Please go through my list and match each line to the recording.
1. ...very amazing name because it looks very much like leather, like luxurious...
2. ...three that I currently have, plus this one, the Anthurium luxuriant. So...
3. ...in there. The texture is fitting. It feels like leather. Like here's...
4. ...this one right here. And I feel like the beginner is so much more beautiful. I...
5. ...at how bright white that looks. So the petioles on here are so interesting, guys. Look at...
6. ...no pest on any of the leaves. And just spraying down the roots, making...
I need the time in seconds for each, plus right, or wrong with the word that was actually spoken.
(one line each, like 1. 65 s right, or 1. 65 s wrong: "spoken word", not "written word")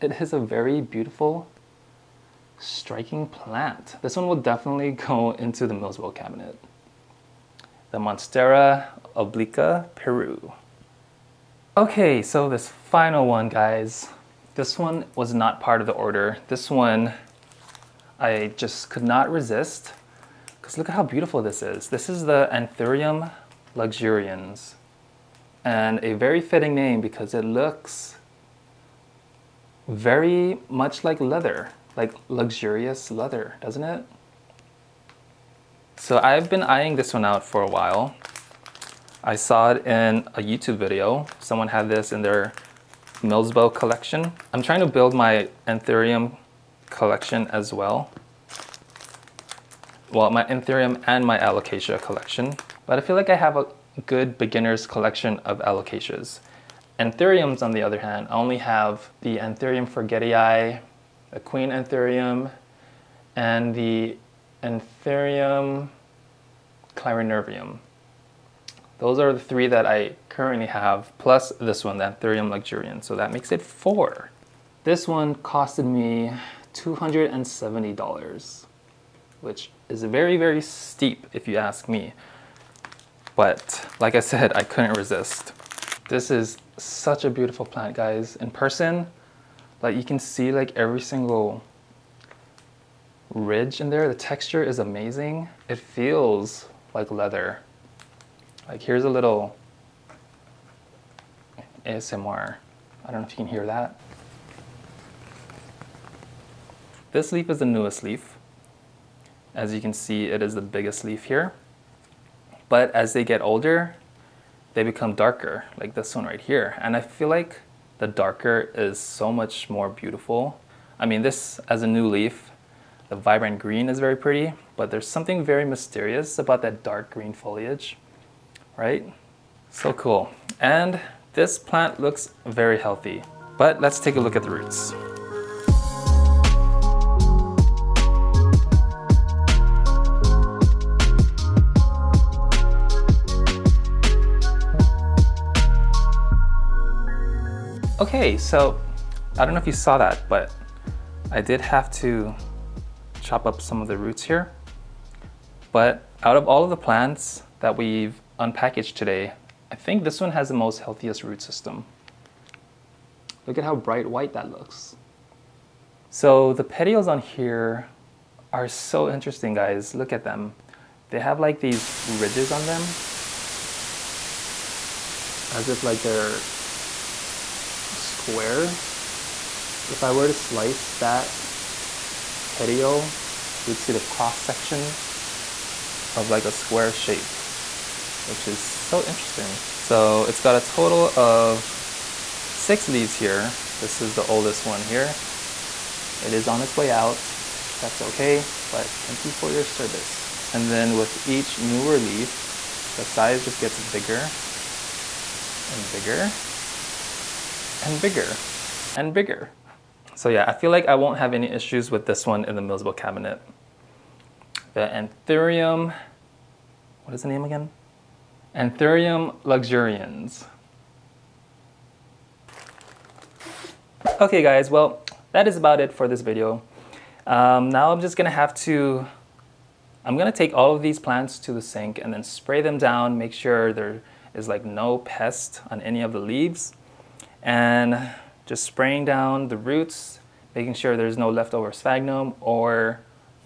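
1. 26 s wrong: "fitting", not "amazing"
2. 69 s right
3. 93 s wrong: "amazing", not "fitting"
4. 115 s wrong: "darker", not "beginner"
5. 163 s right
6. 234 s right.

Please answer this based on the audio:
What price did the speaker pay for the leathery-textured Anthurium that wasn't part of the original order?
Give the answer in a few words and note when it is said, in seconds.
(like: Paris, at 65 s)
$270, at 76 s.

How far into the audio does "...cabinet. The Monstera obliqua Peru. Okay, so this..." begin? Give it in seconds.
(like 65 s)
6 s.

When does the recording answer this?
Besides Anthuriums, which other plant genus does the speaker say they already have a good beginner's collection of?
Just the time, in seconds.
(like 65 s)
55 s.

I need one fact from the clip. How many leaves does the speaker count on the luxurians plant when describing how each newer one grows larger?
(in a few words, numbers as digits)
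6.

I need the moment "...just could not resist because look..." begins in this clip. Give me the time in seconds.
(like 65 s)
18 s.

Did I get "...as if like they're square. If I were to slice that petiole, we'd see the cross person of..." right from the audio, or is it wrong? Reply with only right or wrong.
wrong.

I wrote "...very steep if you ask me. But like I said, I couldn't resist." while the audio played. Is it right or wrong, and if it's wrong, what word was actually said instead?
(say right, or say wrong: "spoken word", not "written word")
right.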